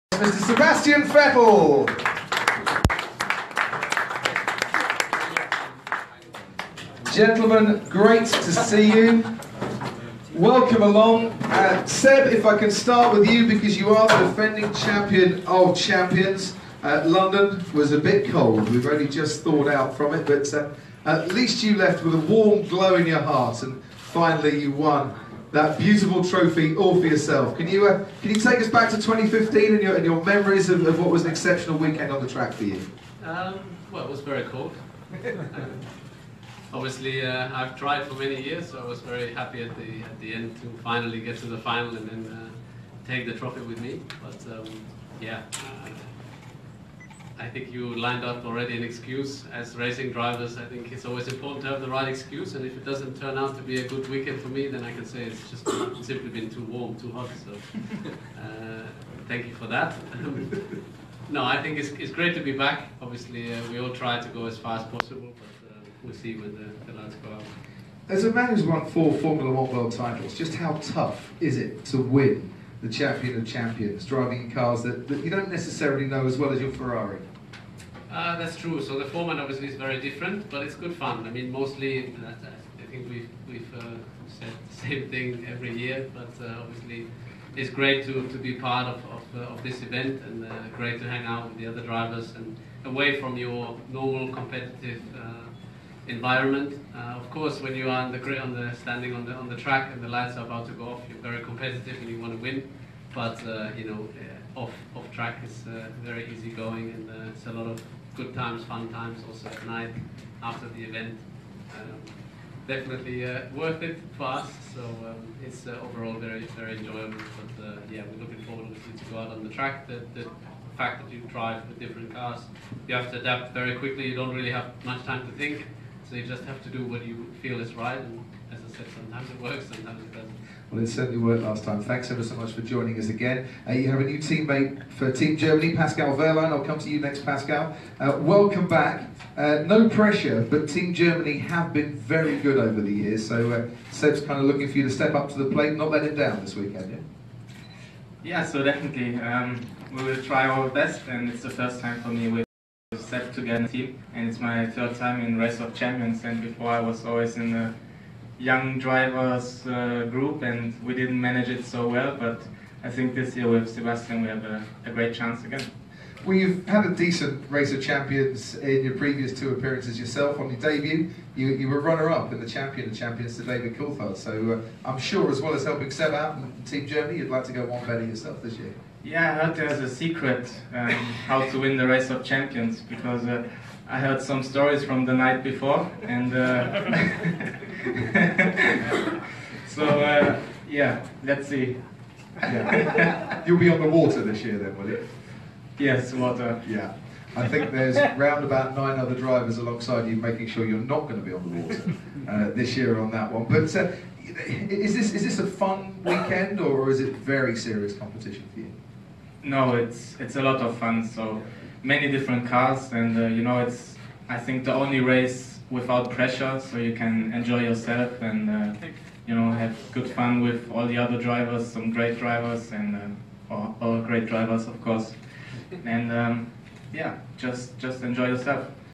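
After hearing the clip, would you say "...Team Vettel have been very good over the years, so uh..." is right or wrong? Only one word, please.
wrong.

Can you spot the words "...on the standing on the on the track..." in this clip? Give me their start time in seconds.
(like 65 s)
98 s.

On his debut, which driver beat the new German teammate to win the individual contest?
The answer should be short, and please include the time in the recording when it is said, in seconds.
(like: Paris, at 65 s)
David Coulthard, at 173 s.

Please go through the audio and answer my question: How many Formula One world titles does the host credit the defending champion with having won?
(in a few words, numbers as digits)
4.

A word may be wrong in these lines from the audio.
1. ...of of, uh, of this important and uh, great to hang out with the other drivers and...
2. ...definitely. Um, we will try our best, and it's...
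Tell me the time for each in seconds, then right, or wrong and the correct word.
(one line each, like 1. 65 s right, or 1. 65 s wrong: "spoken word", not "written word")
1. 88 s wrong: "event", not "important"
2. 148 s right.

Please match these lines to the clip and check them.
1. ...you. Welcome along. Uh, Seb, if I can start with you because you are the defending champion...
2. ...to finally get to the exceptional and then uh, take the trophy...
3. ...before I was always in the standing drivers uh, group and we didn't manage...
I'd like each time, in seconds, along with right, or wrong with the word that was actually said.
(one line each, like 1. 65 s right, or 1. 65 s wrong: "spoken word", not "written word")
1. 8 s right
2. 40 s wrong: "final", not "exceptional"
3. 156 s wrong: "young", not "standing".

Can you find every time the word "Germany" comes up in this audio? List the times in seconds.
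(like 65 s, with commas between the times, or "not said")
135 s, 140 s, 176 s.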